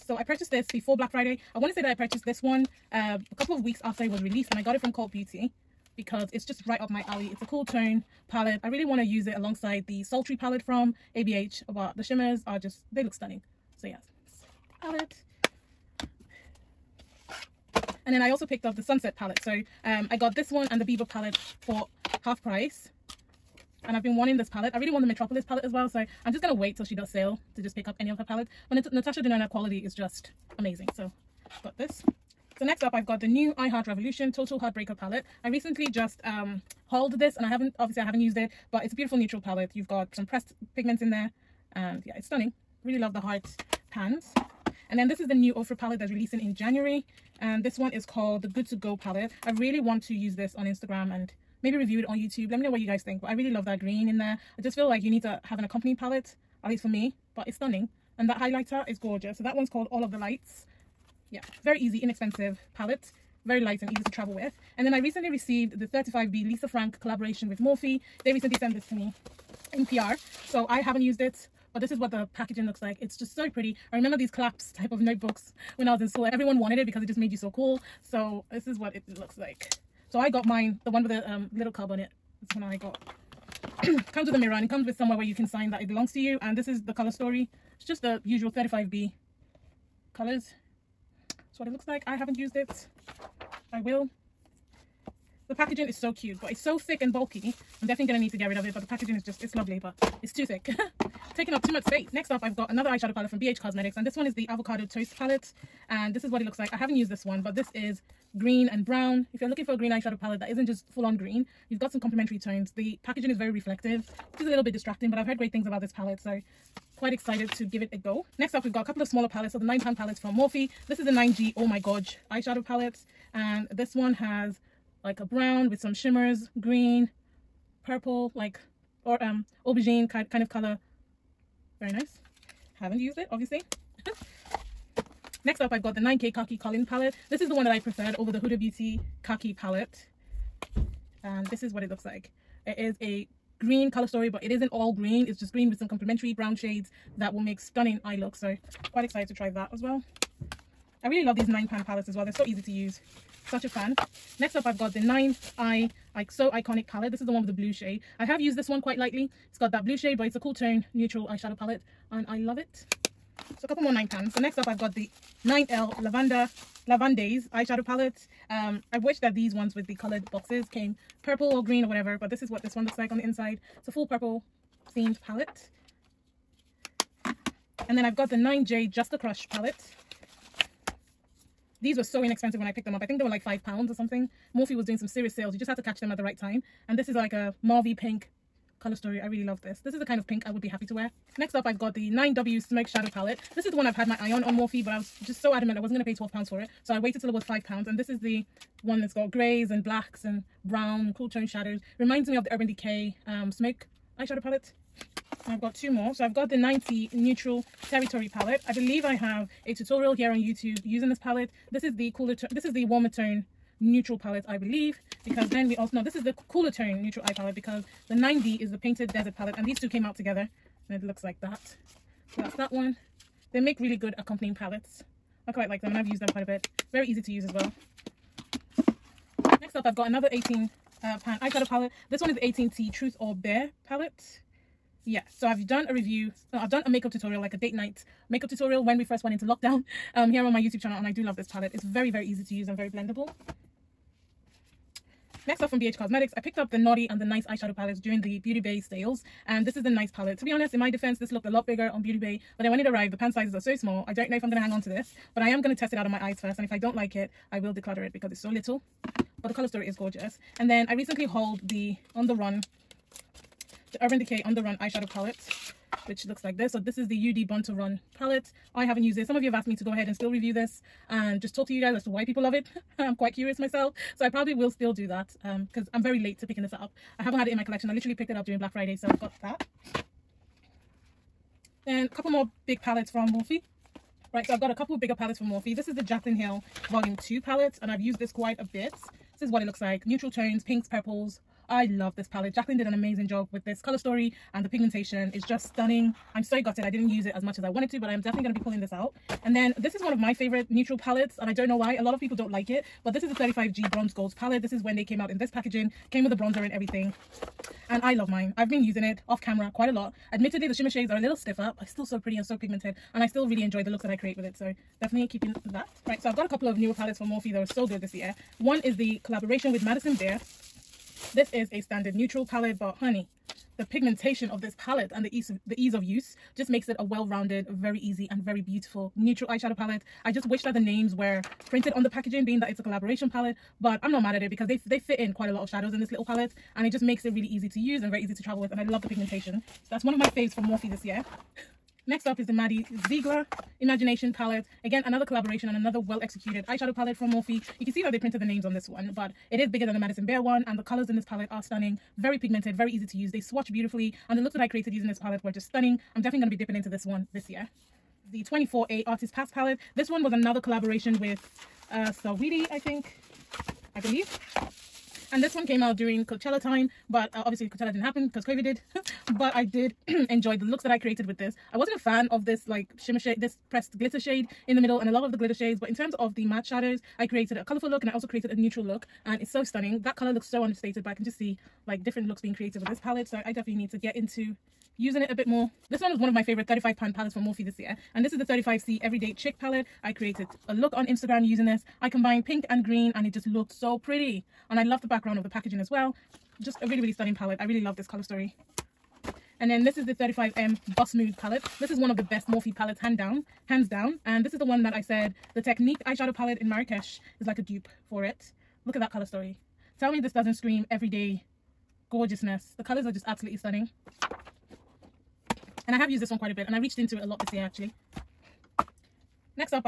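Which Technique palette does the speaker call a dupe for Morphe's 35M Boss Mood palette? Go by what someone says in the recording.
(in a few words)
Marrakesh.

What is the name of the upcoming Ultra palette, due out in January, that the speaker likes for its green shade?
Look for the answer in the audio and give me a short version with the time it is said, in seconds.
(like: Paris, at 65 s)
Good To Go, at 48 s.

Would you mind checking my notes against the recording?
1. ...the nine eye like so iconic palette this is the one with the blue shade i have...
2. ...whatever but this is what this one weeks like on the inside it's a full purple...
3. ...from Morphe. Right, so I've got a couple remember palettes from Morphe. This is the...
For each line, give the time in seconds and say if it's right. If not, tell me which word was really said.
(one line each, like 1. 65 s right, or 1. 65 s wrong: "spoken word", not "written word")
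1. 154 s right
2. 171 s wrong: "looks", not "weeks"
3. 283 s wrong: "bigger", not "remember".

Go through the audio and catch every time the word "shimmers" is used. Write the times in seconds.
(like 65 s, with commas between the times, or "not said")
12 s, 125 s, 310 s, 372 s.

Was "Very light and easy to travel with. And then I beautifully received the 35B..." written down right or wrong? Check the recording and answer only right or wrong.
wrong.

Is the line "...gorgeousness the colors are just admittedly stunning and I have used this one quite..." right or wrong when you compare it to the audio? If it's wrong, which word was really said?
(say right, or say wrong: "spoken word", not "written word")
wrong: "absolutely", not "admittedly".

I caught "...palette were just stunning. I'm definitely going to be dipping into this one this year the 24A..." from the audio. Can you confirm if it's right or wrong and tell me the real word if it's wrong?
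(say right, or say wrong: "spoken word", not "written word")
right.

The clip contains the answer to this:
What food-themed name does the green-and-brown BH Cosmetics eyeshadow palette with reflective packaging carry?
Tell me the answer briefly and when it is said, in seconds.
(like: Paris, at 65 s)
Avocado Toast, at 104 s.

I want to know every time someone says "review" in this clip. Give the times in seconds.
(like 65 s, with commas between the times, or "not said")
51 s, 235 s, 270 s.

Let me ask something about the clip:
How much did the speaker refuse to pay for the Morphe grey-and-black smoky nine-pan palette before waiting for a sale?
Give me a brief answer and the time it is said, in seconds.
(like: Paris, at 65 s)
12 pounds, at 196 s.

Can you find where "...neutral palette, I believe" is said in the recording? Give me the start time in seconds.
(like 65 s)
213 s.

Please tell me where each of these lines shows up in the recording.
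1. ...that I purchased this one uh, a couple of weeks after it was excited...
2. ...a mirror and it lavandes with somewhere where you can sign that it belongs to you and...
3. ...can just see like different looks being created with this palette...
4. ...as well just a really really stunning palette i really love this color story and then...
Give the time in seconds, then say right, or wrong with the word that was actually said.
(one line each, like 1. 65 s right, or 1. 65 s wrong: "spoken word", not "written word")
1. 1 s wrong: "released", not "excited"
2. 84 s wrong: "comes", not "lavandes"
3. 381 s right
4. 395 s right.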